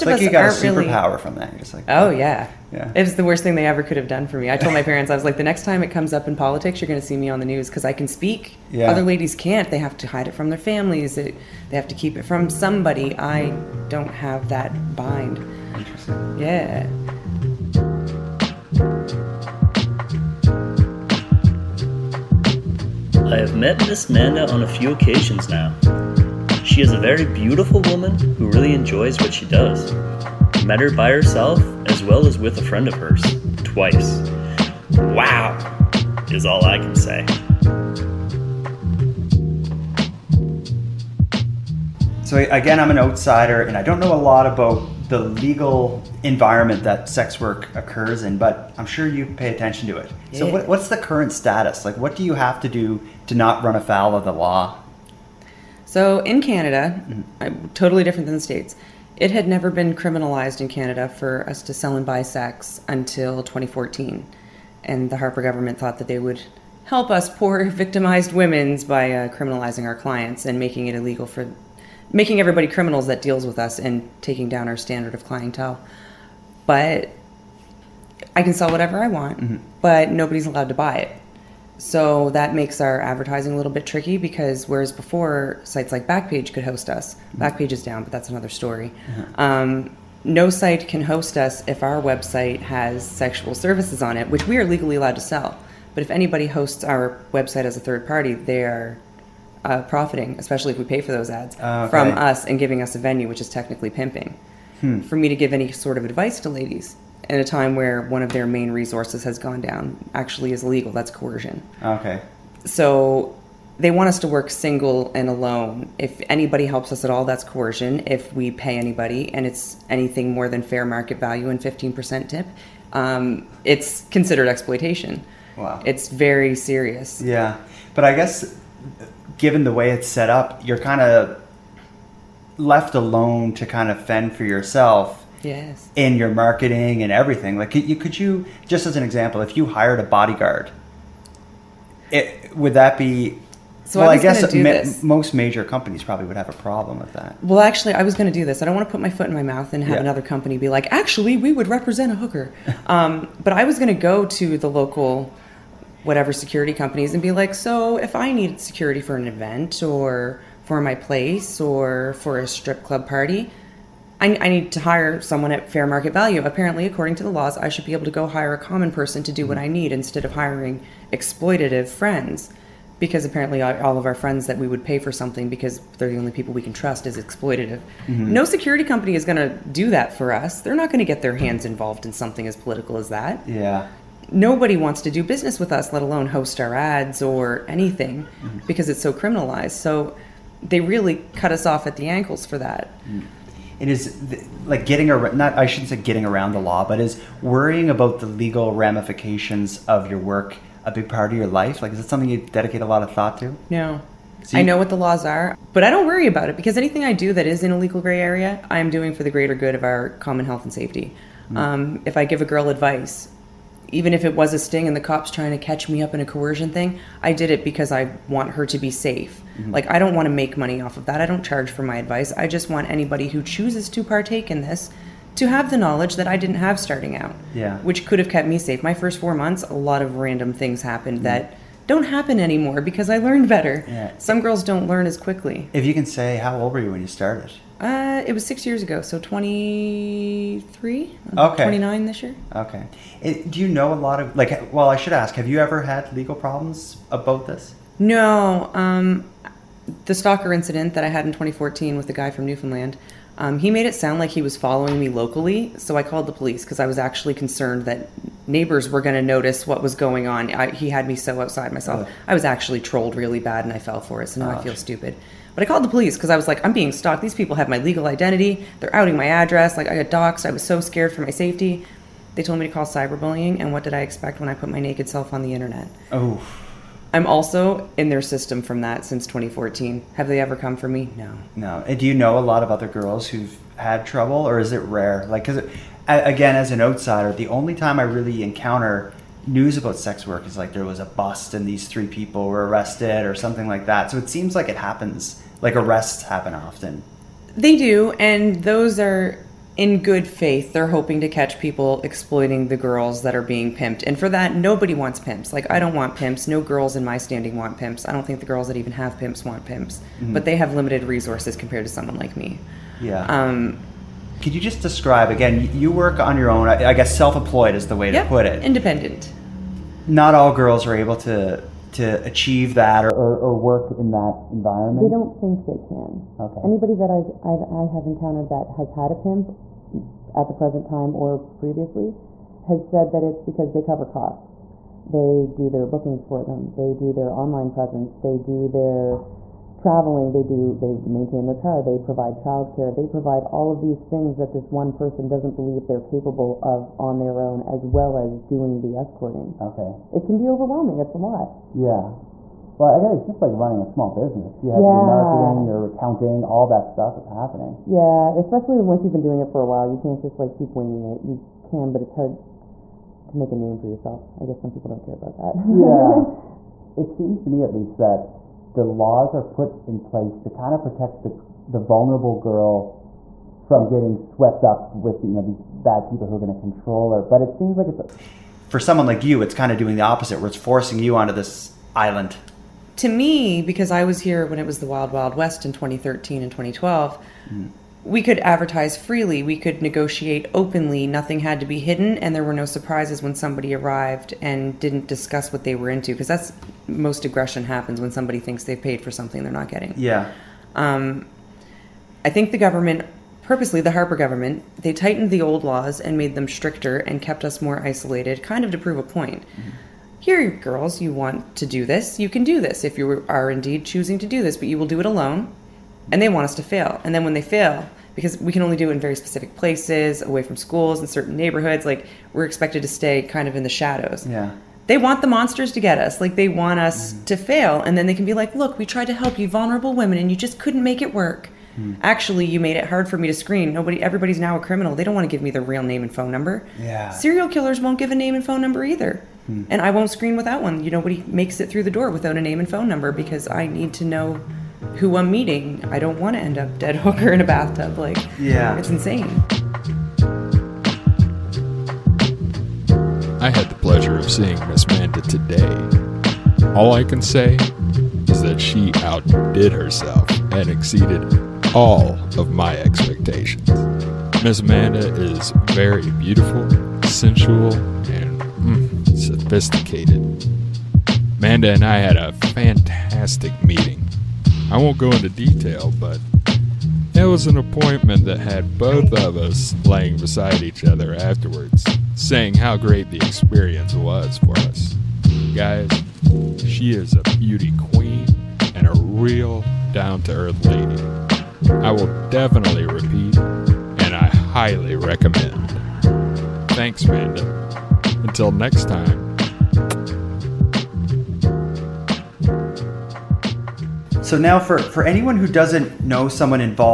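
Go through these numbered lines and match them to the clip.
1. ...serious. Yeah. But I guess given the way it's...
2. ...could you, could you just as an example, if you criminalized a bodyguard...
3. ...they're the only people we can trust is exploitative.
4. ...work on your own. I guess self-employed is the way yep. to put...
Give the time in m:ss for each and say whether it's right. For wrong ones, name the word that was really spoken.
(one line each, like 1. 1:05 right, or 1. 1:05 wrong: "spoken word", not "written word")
1. 2:06 right
2. 2:17 wrong: "hired", not "criminalized"
3. 2:55 right
4. 5:15 right.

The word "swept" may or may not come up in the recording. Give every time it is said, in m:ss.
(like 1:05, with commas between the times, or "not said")
6:14.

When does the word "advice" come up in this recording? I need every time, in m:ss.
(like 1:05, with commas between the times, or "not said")
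1:46, 3:32, 3:41.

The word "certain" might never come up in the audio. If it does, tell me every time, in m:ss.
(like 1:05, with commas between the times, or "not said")
7:01.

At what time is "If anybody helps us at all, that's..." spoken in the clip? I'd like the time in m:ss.
1:55.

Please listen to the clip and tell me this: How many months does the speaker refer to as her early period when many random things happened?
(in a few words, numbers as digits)
4.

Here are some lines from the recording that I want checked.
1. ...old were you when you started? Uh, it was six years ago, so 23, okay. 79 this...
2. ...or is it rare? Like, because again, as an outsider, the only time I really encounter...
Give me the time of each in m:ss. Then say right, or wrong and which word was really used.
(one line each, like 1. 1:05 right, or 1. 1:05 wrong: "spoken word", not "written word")
1. 3:56 wrong: "29", not "79"
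2. 4:44 right.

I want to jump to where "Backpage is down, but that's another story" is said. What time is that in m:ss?
1:27.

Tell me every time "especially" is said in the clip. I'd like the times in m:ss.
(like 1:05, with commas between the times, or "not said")
1:40, 5:58.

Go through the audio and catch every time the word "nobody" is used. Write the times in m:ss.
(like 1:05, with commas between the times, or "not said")
1:20, 3:04, 5:04, 7:13, 7:20.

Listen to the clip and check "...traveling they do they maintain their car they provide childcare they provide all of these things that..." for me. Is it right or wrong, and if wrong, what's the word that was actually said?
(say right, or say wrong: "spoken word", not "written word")
right.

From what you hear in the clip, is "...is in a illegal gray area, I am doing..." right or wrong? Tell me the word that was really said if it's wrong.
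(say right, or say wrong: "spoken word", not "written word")
wrong: "legal", not "illegal".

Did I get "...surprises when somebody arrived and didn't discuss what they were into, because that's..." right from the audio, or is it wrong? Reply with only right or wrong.
right.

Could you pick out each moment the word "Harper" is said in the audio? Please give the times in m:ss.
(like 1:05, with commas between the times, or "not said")
1:05, 6:43.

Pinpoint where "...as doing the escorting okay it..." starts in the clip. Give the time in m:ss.
5:48.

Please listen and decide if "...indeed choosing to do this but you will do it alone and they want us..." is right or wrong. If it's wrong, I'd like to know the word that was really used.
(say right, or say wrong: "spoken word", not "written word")
right.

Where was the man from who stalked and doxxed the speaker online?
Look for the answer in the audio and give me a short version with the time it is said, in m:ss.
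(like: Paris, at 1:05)
Newfoundland, at 4:12.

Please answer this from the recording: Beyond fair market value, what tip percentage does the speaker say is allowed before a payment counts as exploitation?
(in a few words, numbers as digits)
15%.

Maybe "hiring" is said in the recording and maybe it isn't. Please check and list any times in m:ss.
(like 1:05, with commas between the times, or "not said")
2:50.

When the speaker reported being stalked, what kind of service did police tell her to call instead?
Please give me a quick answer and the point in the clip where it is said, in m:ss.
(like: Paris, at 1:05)
cyberbullying, at 4:32.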